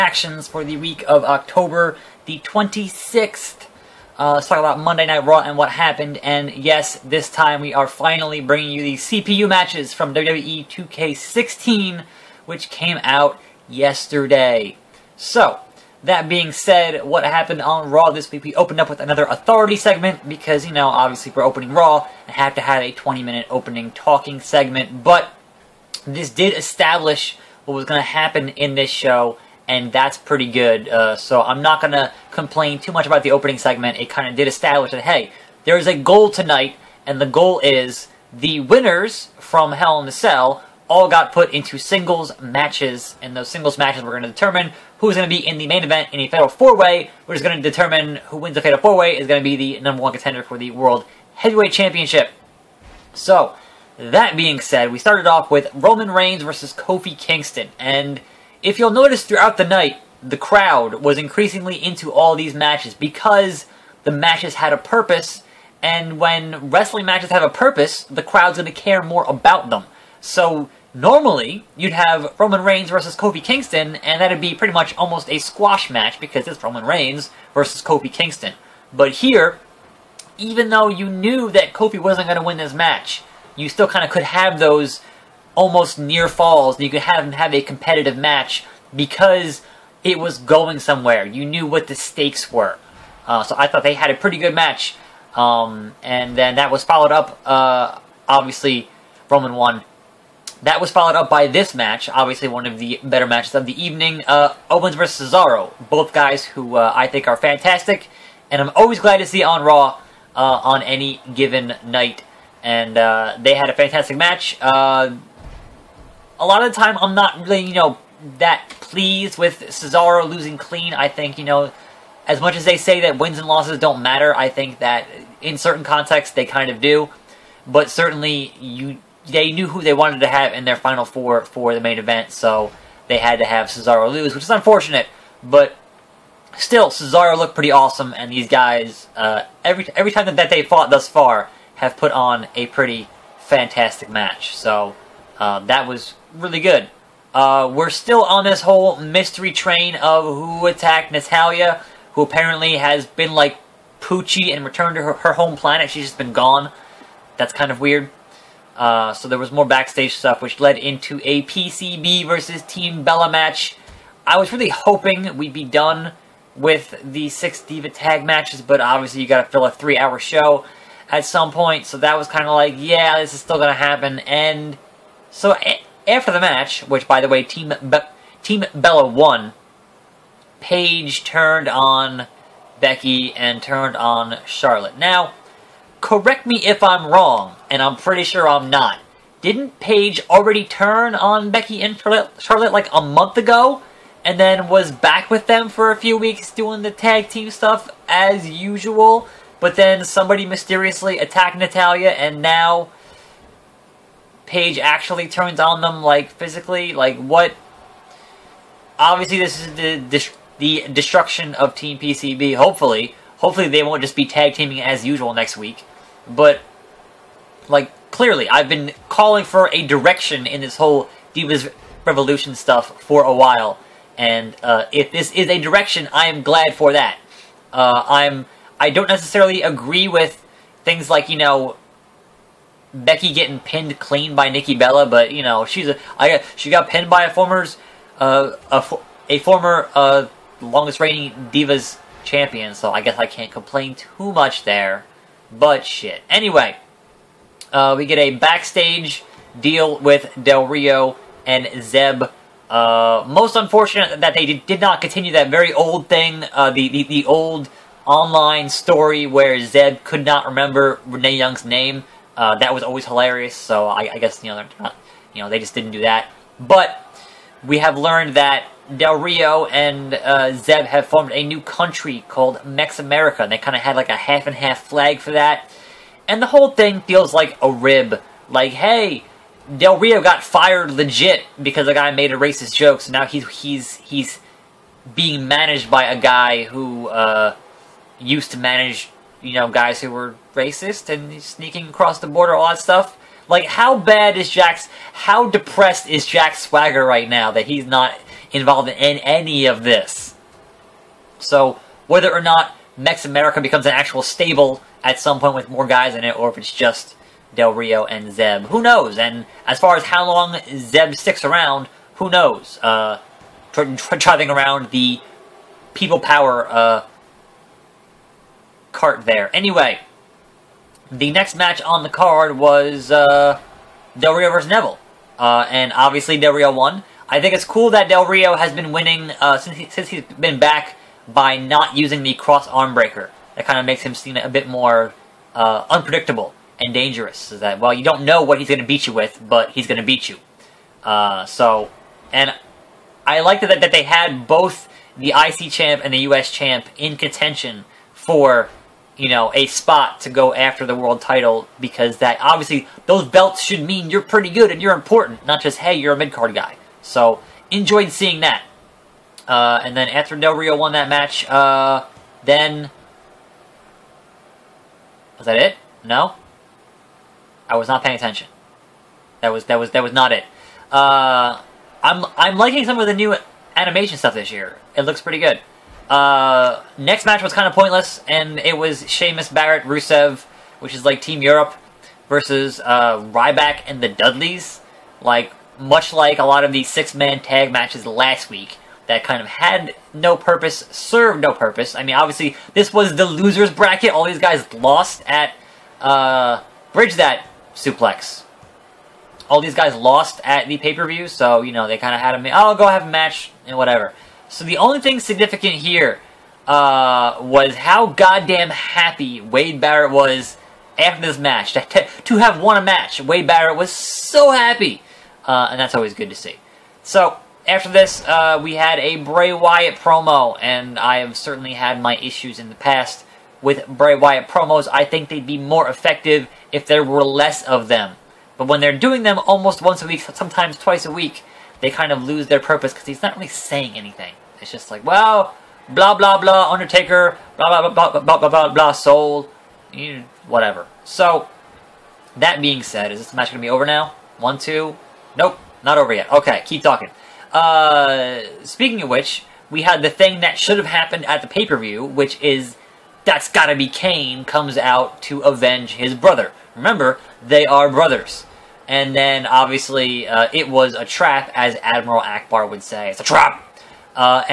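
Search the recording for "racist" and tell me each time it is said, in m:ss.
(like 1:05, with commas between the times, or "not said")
4:42, 4:50.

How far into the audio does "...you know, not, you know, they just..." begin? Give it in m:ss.
4:24.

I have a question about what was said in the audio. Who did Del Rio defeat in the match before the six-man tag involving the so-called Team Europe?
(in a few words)
Neville.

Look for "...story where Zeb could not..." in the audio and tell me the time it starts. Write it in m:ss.
4:18.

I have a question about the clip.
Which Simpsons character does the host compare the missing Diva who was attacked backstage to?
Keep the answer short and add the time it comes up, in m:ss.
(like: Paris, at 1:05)
Poochie, at 2:33.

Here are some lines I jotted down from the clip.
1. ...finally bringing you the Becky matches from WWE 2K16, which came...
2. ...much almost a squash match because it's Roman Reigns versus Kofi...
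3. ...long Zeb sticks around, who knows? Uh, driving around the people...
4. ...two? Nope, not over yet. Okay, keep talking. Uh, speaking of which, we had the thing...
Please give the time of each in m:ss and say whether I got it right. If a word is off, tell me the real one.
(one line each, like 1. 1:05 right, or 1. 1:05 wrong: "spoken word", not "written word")
1. 0:07 wrong: "CPU", not "Becky"
2. 1:14 right
3. 5:10 right
4. 7:24 right.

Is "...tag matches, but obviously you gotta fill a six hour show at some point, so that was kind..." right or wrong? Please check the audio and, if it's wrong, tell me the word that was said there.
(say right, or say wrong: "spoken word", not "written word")
wrong: "three", not "six".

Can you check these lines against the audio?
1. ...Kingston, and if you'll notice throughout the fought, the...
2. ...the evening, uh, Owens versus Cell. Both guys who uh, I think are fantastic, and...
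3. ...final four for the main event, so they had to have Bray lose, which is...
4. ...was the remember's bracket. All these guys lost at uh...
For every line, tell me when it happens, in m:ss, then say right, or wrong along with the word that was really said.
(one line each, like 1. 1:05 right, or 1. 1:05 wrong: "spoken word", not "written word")
1. 0:57 wrong: "night", not "fought"
2. 1:43 wrong: "Cesaro", not "Cell"
3. 2:10 wrong: "Cesaro", not "Bray"
4. 6:32 wrong: "loser", not "remember".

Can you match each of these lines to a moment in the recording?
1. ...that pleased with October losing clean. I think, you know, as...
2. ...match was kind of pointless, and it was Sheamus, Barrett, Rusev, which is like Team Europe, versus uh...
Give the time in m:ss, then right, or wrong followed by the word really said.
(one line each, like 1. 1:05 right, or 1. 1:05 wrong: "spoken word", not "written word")
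1. 1:58 wrong: "Cesaro", not "October"
2. 6:17 right.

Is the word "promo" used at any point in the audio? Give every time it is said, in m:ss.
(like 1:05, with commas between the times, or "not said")
6:59, 7:04.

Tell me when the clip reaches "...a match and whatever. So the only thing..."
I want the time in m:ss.
6:43.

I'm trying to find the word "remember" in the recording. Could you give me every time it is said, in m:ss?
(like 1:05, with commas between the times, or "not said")
4:20, 7:36.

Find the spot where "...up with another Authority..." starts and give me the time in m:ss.
0:18.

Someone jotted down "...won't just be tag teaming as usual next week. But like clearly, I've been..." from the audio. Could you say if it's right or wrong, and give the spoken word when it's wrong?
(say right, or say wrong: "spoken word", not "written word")
right.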